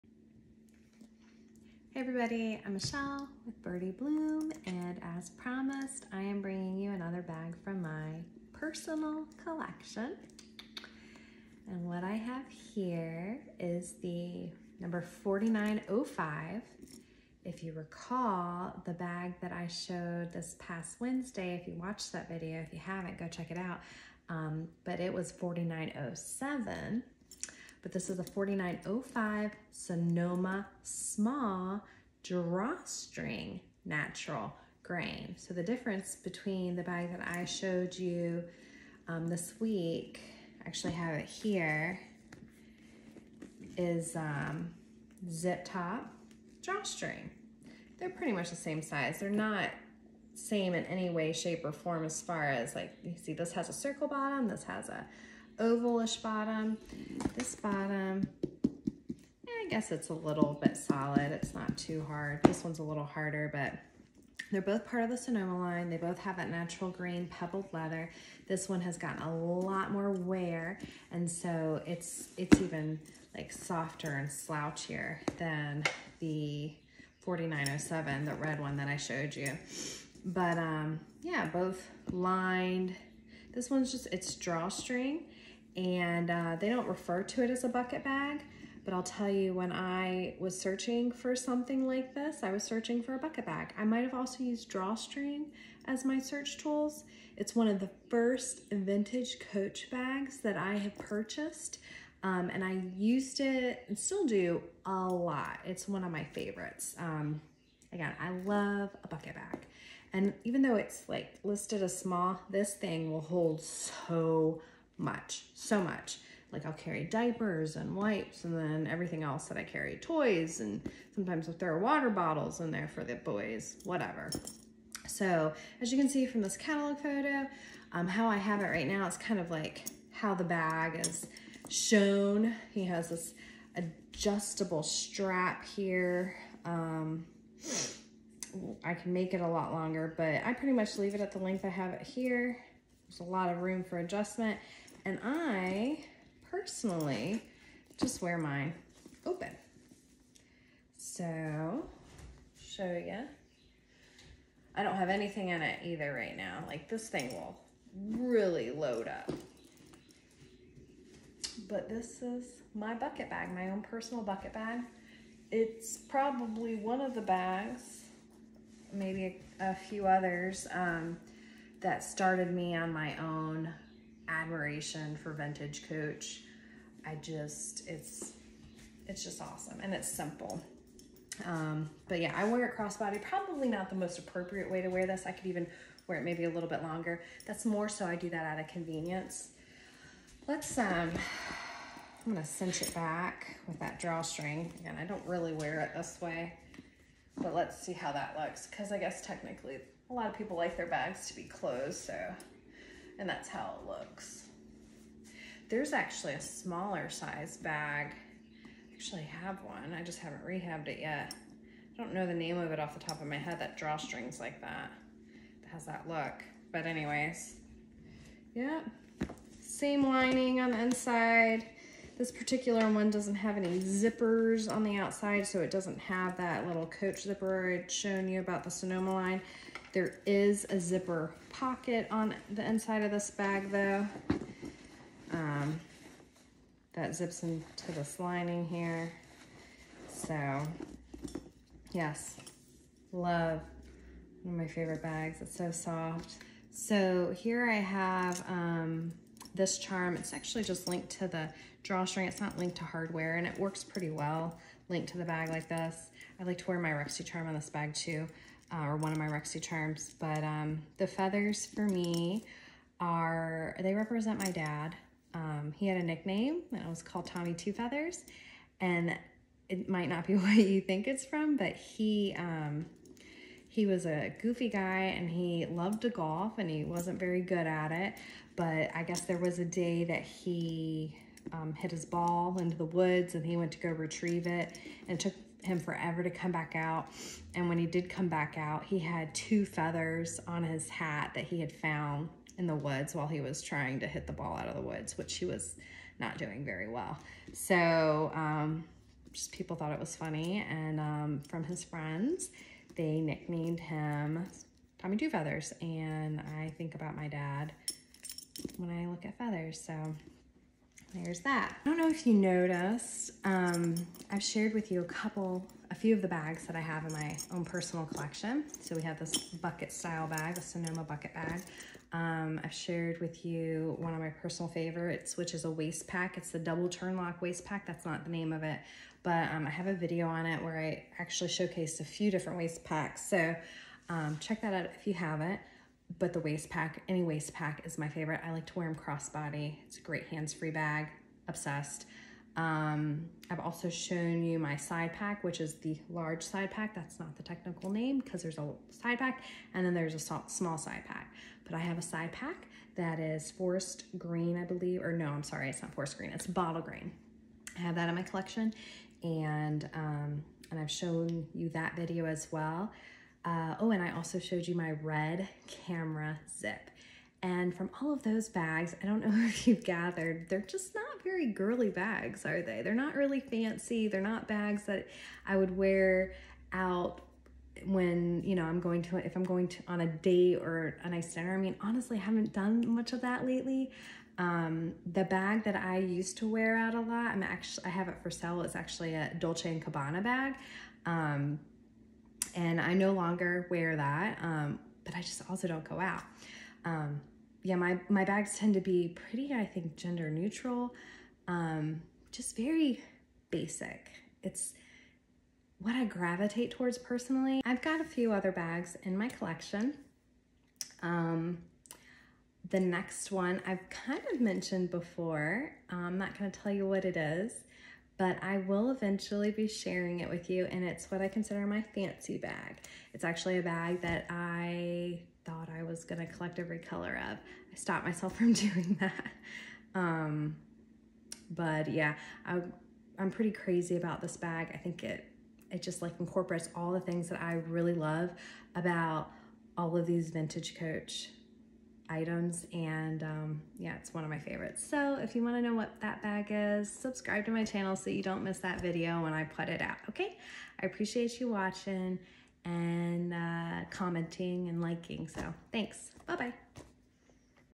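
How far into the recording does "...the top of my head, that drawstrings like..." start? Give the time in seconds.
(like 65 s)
212 s.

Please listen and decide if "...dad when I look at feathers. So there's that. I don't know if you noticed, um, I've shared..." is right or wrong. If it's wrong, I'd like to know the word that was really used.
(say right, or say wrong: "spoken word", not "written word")
right.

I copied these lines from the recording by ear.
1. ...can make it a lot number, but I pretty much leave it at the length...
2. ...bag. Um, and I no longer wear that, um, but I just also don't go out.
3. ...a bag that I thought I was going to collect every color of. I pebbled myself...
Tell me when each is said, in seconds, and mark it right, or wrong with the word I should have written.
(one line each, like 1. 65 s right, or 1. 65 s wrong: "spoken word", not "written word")
1. 138 s wrong: "longer", not "number"
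2. 390 s right
3. 423 s wrong: "stopped", not "pebbled".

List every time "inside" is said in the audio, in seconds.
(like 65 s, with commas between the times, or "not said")
220 s, 232 s.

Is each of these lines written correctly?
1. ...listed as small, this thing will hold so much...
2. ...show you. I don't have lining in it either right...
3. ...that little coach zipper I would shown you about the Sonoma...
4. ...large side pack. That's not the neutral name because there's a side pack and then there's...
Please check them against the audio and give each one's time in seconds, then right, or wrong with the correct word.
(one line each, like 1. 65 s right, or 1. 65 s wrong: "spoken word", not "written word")
1. 111 s right
2. 152 s wrong: "anything", not "lining"
3. 226 s right
4. 346 s wrong: "technical", not "neutral".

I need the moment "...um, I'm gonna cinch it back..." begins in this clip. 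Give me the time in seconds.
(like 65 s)
190 s.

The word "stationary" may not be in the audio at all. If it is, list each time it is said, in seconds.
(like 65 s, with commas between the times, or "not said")
not said.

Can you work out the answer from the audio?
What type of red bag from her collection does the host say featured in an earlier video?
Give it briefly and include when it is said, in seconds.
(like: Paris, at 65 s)
camera zip, at 365 s.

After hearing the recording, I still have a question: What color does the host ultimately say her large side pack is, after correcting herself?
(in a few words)
bottle green.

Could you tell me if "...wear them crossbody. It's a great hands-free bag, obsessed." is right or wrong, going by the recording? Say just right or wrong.
right.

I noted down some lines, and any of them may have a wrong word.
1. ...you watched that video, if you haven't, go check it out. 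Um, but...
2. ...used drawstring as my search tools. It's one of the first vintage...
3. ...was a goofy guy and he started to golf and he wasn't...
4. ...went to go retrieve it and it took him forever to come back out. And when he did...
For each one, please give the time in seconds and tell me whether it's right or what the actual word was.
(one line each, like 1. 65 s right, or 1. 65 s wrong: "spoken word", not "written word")
1. 21 s right
2. 94 s right
3. 273 s wrong: "loved", not "started"
4. 283 s right.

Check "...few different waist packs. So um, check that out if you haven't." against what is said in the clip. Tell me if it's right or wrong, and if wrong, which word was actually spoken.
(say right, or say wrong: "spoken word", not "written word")
right.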